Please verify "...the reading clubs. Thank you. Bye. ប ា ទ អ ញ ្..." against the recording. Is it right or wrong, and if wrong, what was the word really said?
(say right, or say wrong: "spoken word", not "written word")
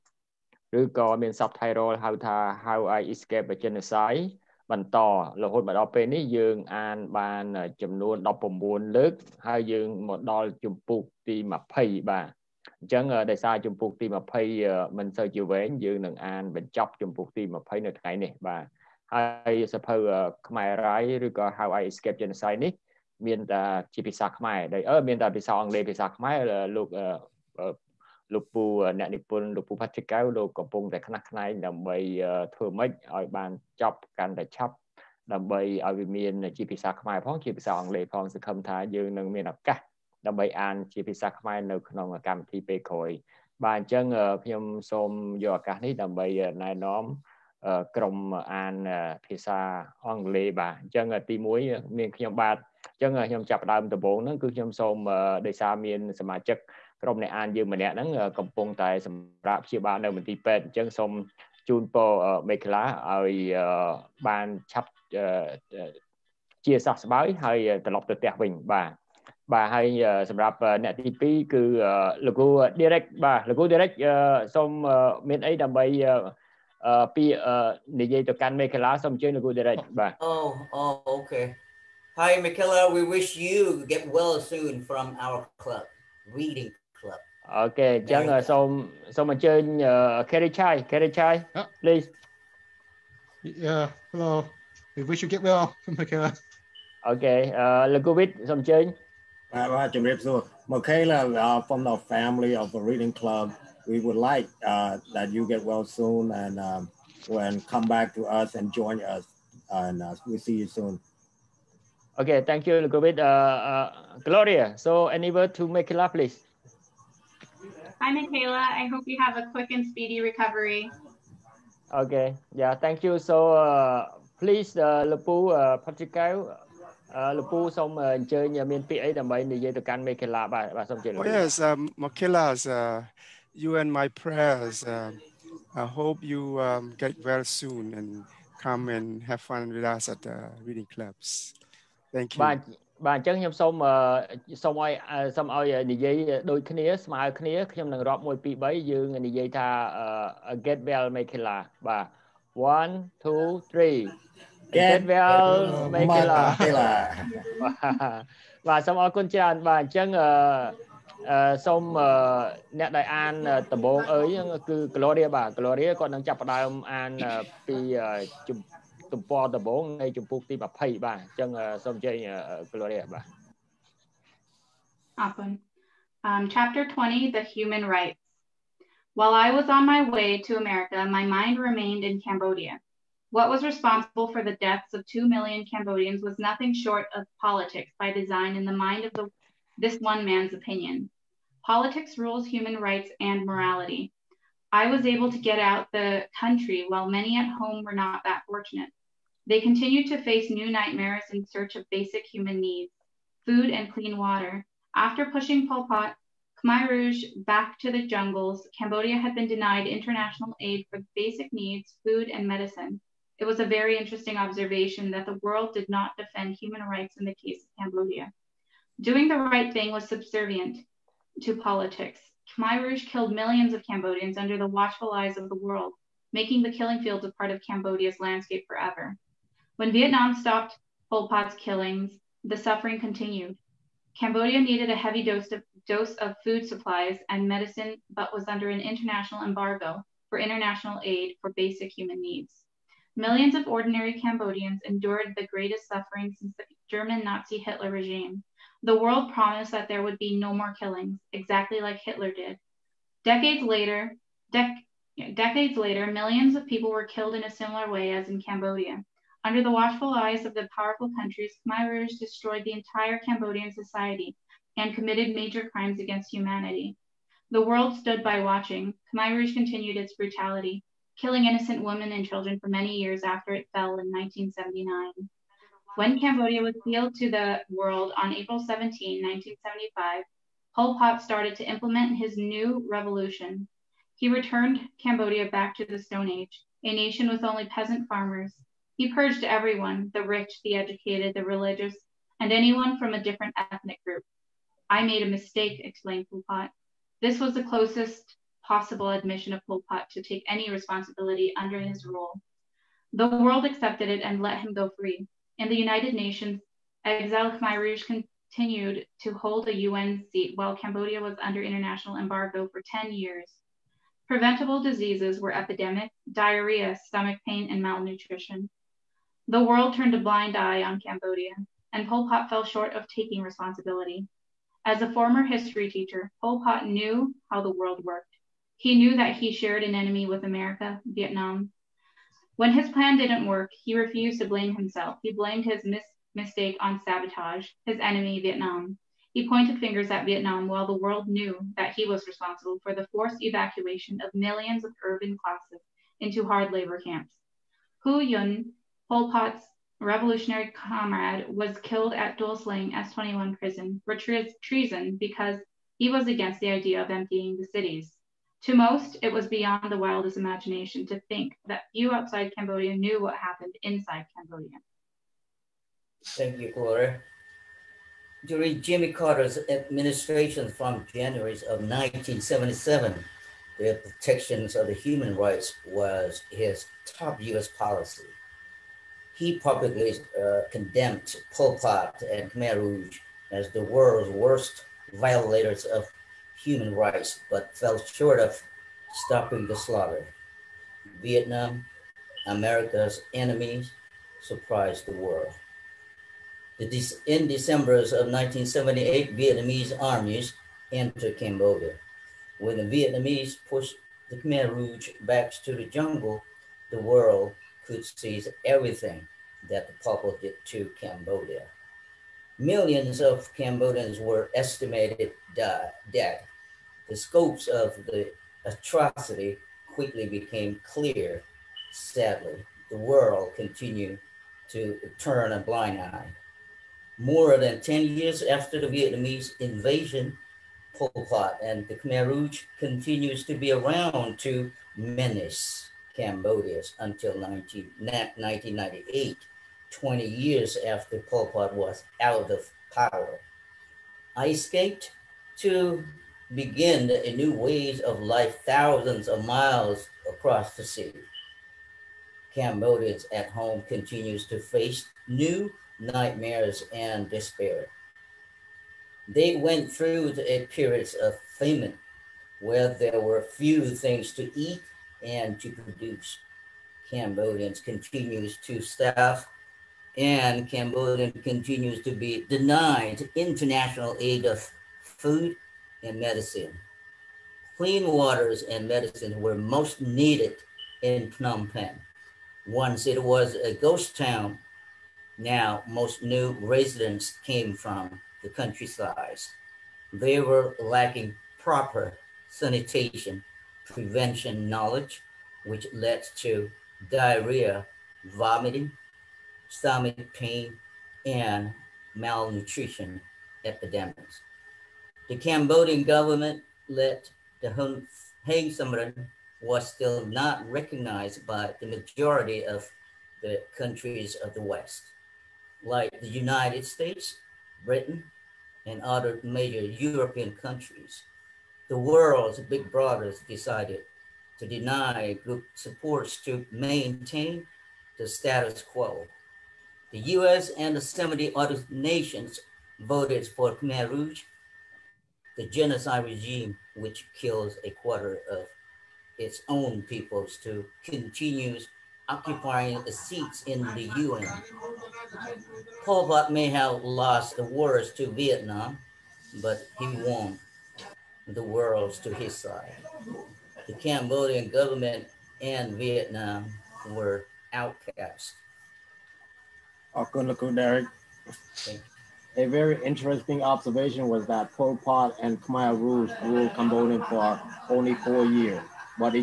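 right.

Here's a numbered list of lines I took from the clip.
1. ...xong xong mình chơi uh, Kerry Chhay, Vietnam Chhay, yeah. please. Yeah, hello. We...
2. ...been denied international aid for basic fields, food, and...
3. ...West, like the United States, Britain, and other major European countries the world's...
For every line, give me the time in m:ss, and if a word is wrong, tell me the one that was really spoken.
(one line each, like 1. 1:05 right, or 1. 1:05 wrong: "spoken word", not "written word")
1. 1:28 wrong: "Kerry", not "Vietnam"
2. 3:29 wrong: "needs", not "fields"
3. 8:34 right.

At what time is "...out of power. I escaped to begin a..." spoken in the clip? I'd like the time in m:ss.
7:22.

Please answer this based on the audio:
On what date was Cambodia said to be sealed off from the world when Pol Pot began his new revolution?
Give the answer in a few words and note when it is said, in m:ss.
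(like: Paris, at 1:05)
April 17, 1975, at 4:38.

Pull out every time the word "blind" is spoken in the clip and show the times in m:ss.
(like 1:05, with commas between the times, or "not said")
5:20, 7:05.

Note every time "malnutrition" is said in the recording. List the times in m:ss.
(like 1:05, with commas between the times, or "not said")
5:17, 8:22.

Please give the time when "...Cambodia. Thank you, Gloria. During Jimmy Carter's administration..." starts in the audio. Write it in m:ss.
6:04.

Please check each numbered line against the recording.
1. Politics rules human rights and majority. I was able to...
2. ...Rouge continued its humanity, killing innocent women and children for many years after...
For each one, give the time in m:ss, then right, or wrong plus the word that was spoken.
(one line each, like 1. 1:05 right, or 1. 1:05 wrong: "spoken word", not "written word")
1. 3:11 wrong: "morality", not "majority"
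2. 4:29 wrong: "brutality", not "humanity".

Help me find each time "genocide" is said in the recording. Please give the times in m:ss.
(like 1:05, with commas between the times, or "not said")
0:03, 0:22, 8:55.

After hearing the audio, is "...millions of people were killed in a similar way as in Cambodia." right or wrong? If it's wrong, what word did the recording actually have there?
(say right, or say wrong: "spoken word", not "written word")
right.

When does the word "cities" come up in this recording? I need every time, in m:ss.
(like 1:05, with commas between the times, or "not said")
5:57.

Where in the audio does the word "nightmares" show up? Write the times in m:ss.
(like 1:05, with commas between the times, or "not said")
3:20, 7:35.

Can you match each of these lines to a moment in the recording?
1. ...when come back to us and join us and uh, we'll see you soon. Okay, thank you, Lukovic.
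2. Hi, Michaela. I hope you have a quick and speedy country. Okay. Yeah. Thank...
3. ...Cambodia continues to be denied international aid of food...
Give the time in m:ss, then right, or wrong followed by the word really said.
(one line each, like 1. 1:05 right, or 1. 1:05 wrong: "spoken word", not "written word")
1. 1:47 right
2. 1:58 wrong: "recovery", not "country"
3. 7:50 right.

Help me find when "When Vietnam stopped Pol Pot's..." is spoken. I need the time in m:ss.
3:49.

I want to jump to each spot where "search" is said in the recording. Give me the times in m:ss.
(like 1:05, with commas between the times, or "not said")
3:21.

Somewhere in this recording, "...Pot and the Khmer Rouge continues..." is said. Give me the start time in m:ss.
7:11.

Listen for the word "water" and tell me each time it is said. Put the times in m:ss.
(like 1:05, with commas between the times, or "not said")
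3:24, 7:58.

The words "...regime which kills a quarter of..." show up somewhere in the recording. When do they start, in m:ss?
8:56.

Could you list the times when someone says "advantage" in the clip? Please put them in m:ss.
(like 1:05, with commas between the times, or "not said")
not said.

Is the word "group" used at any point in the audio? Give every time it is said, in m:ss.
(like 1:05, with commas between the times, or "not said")
4:54, 8:45.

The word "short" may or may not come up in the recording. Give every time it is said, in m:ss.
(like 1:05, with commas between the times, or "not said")
3:06, 5:22, 6:28.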